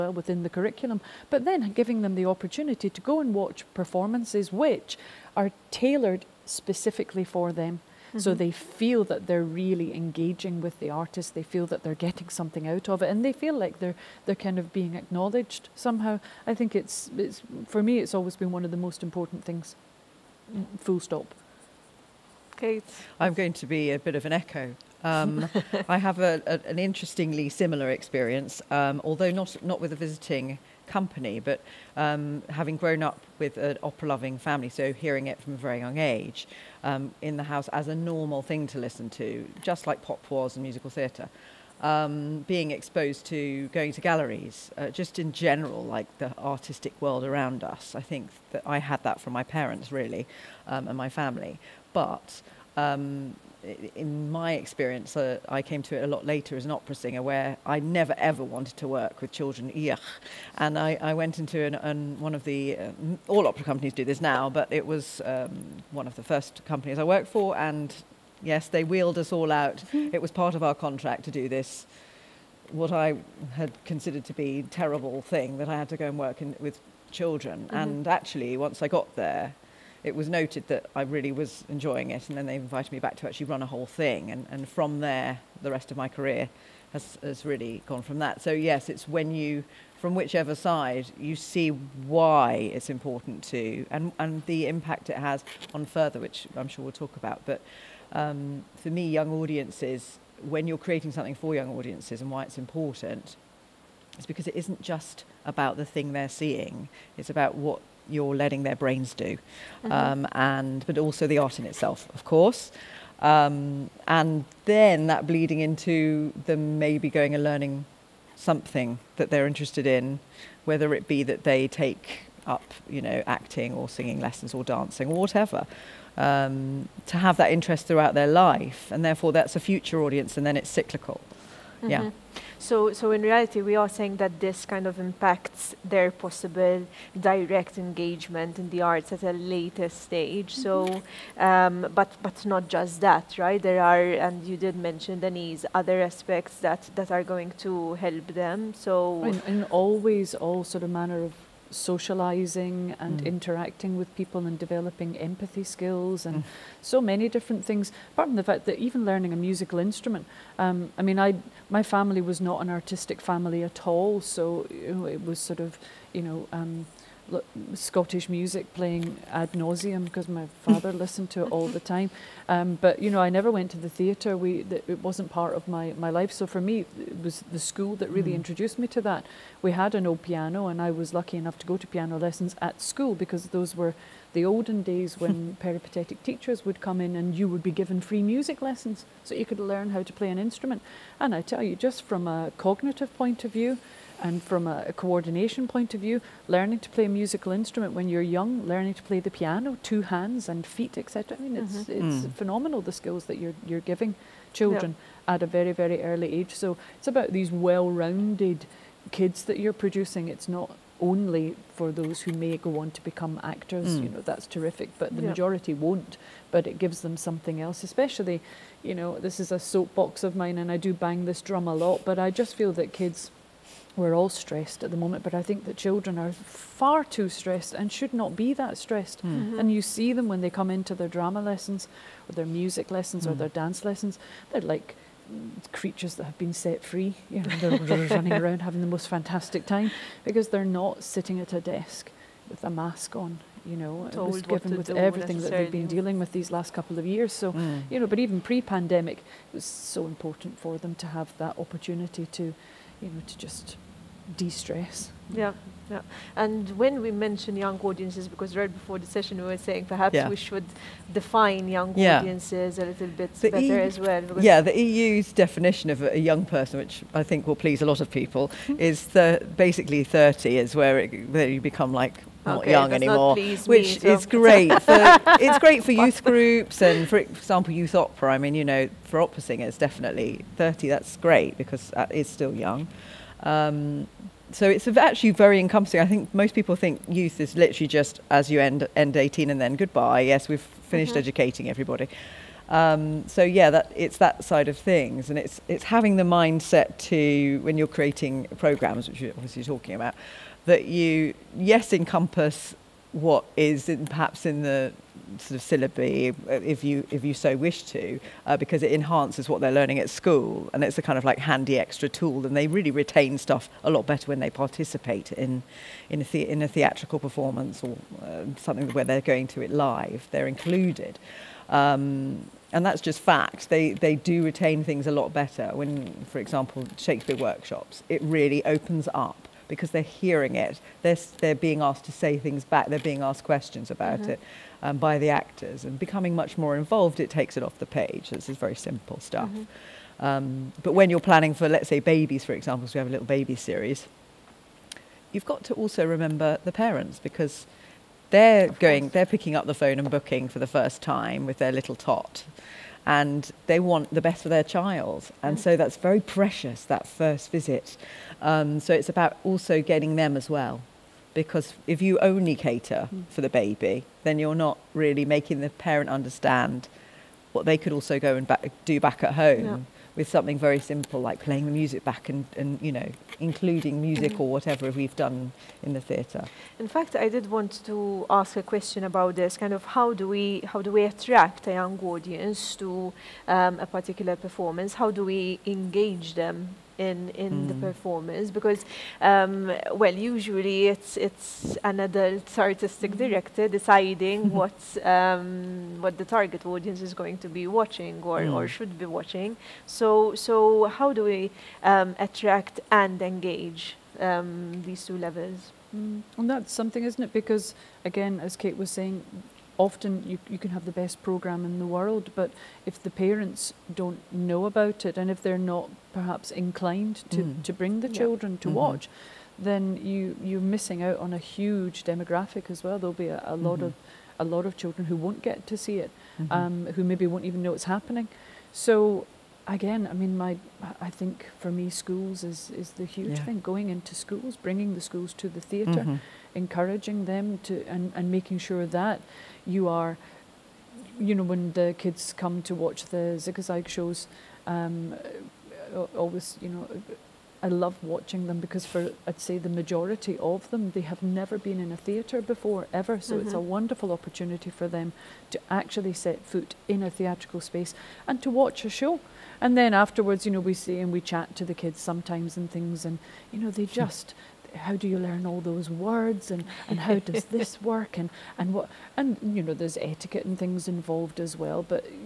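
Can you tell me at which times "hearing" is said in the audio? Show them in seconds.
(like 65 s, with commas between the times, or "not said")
34 s, 330 s.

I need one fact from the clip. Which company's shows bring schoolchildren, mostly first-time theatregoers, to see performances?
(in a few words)
ZiguZajg.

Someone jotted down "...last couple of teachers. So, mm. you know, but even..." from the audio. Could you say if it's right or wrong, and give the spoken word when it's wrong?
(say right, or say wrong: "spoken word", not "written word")
wrong: "years", not "teachers".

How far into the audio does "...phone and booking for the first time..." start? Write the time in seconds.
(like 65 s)
349 s.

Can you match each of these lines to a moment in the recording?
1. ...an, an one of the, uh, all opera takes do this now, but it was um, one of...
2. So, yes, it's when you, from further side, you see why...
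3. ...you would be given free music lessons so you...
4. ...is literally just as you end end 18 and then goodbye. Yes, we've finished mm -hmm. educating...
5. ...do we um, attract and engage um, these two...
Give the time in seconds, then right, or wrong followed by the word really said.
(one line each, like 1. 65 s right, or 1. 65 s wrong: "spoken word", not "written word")
1. 61 s wrong: "companies", not "takes"
2. 88 s wrong: "whichever", not "further"
3. 187 s right
4. 287 s right
5. 401 s right.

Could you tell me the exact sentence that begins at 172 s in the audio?
Um, but you know, I never went to the theatre.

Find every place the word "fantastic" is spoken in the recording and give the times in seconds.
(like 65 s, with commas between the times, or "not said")
239 s.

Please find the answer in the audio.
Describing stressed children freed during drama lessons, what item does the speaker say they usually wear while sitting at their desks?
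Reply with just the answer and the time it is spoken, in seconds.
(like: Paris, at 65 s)
a mask, at 242 s.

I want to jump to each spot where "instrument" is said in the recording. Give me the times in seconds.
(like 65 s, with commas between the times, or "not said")
159 s, 190 s, 197 s.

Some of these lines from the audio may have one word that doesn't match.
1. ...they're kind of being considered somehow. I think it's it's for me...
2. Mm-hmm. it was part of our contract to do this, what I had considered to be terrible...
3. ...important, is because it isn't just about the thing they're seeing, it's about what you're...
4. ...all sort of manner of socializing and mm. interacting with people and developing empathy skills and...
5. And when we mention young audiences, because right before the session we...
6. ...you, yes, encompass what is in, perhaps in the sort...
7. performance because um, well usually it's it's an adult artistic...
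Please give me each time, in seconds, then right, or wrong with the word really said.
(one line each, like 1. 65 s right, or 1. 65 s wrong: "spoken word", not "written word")
1. 14 s wrong: "acknowledged", not "considered"
2. 69 s right
3. 102 s right
4. 150 s right
5. 256 s right
6. 300 s right
7. 387 s right.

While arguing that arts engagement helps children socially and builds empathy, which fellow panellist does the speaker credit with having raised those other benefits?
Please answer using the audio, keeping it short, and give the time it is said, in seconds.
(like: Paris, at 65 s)
Denise, at 145 s.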